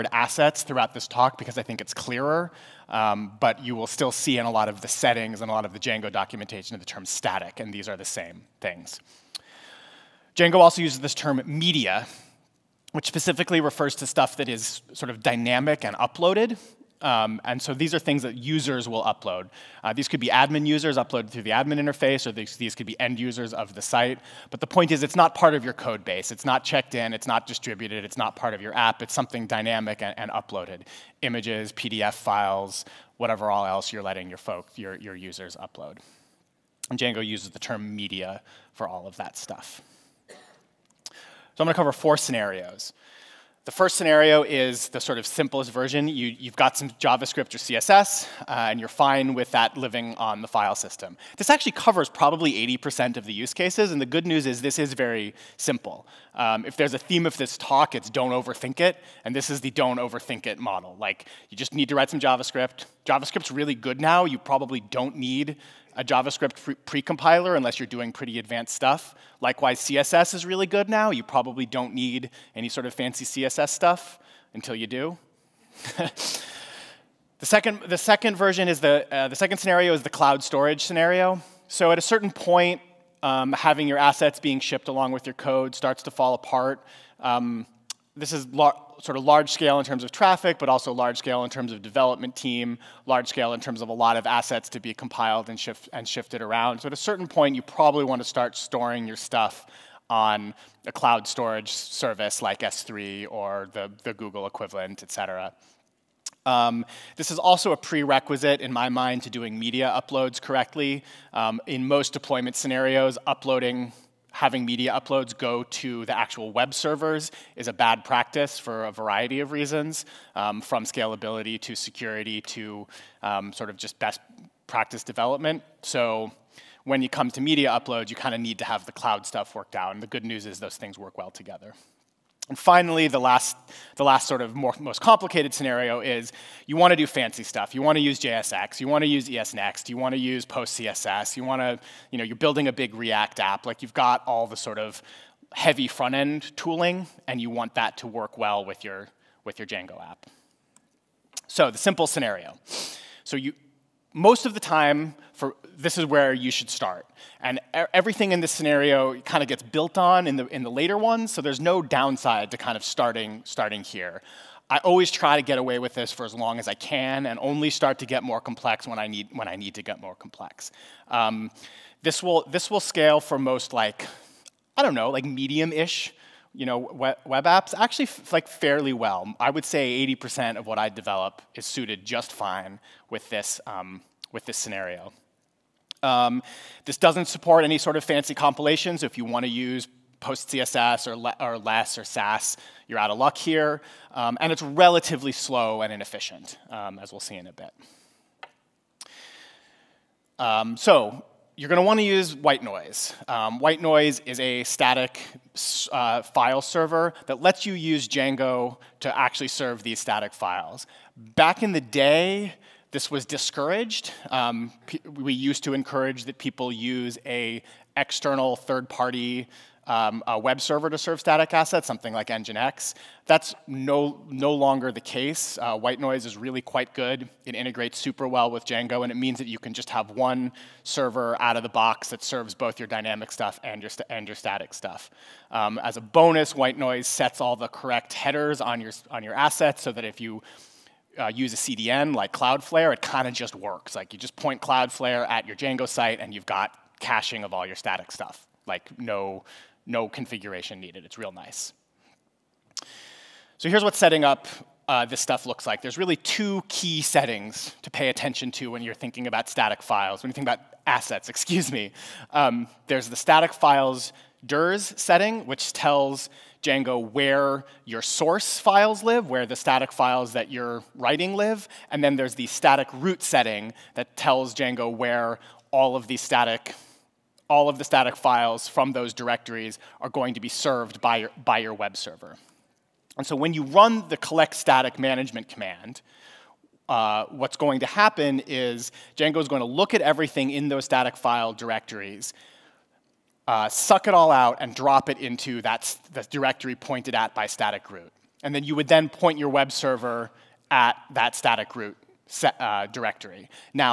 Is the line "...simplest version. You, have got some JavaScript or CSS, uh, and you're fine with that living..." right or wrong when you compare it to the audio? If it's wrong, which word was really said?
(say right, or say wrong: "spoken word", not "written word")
right.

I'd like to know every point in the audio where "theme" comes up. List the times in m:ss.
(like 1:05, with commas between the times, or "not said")
0:56.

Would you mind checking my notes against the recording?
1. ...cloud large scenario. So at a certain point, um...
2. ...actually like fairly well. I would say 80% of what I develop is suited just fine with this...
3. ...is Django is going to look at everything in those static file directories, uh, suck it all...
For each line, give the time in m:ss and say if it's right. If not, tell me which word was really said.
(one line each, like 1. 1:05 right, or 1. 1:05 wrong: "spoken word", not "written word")
1. 1:20 wrong: "storage", not "large"
2. 2:57 right
3. 4:48 right.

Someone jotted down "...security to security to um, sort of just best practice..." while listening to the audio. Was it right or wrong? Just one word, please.
wrong.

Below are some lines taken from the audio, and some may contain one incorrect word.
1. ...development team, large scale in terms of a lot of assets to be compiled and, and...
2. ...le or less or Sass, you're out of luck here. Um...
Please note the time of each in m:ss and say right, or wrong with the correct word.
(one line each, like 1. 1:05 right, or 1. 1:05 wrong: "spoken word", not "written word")
1. 1:31 right
2. 3:11 right.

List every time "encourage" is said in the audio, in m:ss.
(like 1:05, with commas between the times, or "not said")
3:35.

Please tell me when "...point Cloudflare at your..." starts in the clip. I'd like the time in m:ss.
4:04.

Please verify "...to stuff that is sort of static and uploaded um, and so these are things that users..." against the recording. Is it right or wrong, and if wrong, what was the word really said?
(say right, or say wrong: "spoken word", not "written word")
wrong: "dynamic", not "static".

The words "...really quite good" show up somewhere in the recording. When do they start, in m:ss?
3:46.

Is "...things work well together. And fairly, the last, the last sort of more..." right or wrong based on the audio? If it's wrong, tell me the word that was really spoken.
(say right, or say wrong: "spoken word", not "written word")
wrong: "finally", not "fairly".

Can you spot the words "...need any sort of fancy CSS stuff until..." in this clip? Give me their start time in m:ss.
1:11.